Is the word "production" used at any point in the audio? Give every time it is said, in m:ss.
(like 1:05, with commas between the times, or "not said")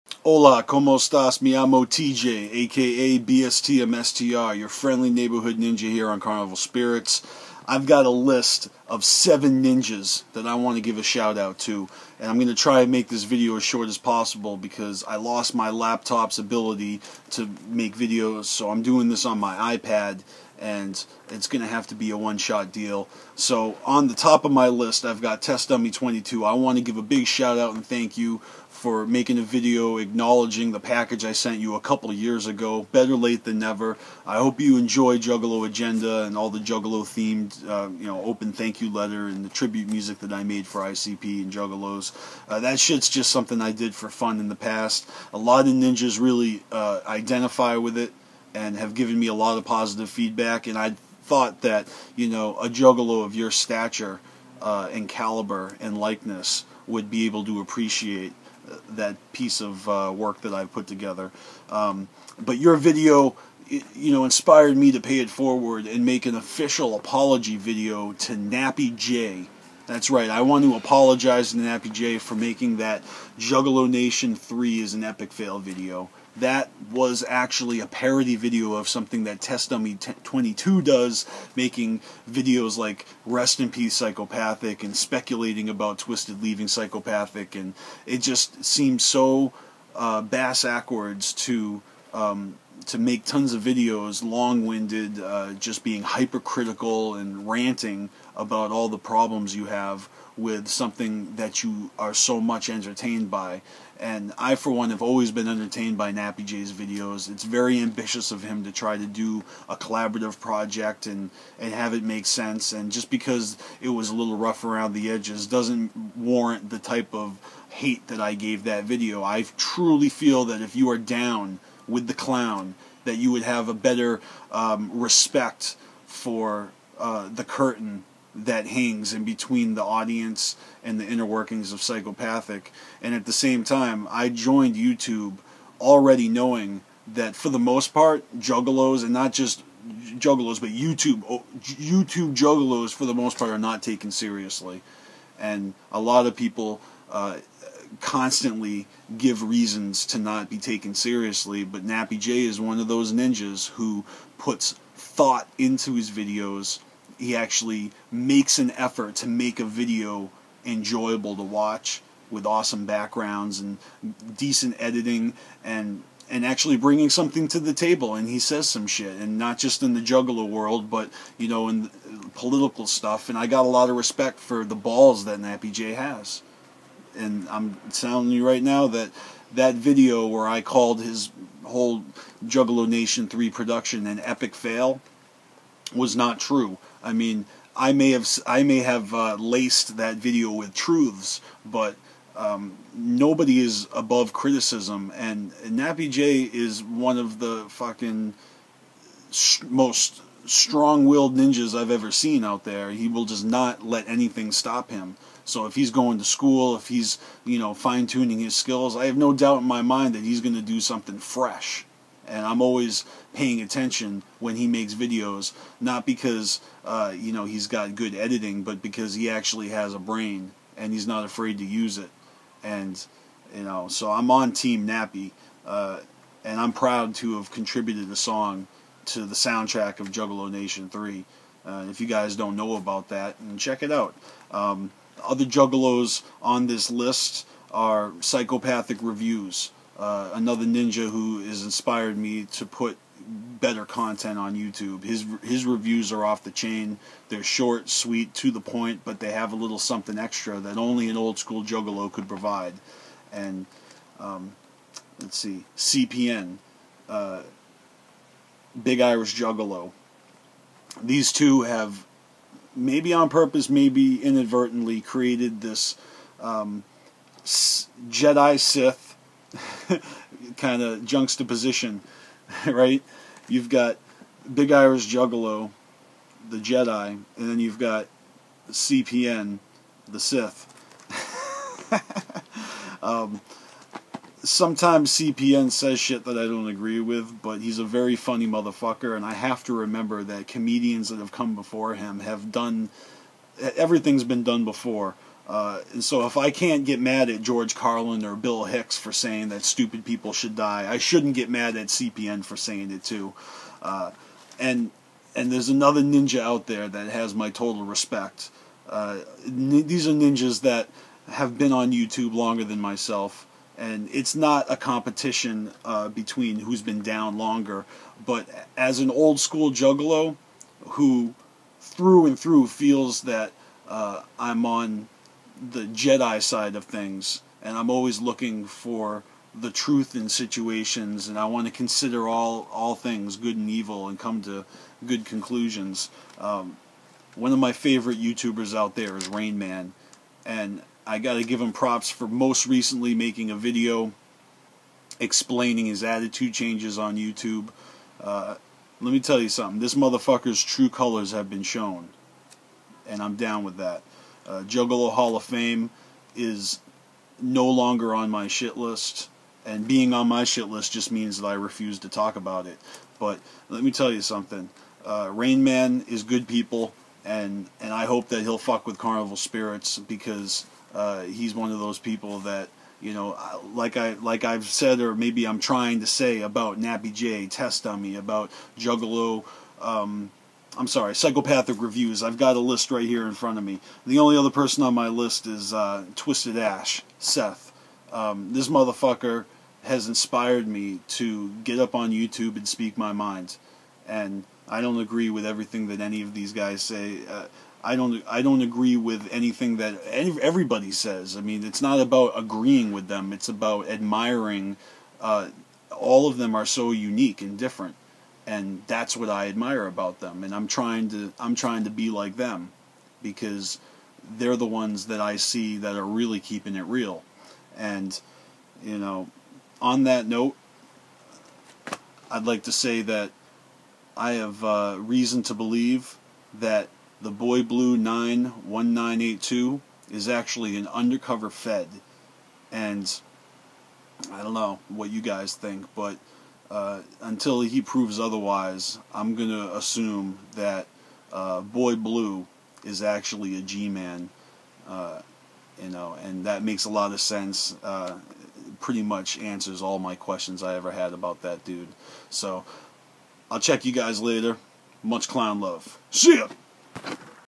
3:03.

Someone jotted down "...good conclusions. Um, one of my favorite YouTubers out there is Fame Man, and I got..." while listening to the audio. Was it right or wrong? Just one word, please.
wrong.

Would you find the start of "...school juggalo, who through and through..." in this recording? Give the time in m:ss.
5:19.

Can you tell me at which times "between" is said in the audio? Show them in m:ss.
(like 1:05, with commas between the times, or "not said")
2:09, 5:16.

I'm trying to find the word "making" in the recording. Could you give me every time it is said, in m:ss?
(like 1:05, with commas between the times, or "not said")
0:29, 1:12, 1:21, 5:43.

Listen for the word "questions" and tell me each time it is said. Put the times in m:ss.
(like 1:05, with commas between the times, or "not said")
7:30.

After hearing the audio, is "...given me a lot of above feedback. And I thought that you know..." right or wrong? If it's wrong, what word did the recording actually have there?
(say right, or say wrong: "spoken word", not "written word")
wrong: "positive", not "above".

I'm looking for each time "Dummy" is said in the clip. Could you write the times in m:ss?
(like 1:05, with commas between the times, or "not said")
0:25, 1:19, 6:17.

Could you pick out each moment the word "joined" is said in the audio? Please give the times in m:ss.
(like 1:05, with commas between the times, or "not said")
2:14.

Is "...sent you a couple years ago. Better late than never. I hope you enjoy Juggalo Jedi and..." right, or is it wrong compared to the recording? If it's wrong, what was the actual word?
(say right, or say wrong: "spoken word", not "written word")
wrong: "Agenda", not "Jedi".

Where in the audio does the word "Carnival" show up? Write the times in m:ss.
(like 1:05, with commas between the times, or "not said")
0:06, 6:08.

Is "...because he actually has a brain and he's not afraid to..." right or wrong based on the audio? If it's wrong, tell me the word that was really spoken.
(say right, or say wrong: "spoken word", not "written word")
right.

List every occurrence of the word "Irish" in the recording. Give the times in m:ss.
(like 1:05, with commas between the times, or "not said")
4:19, 4:34.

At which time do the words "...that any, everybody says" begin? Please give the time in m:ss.
6:39.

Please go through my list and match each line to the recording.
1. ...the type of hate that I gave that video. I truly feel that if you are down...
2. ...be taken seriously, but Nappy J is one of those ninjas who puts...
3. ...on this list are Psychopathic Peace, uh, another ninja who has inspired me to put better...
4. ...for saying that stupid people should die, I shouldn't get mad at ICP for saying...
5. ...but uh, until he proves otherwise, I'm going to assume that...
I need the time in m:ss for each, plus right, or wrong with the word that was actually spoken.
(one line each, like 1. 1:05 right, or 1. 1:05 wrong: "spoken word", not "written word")
1. 1:56 right
2. 2:30 right
3. 3:56 wrong: "Reviews", not "Peace"
4. 4:58 wrong: "CPN", not "ICP"
5. 7:15 right.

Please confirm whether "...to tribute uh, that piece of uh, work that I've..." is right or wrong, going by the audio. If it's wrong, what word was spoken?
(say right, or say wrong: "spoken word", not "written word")
wrong: "appreciate", not "tribute".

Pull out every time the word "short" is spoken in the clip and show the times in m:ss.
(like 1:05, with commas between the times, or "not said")
0:13, 4:07.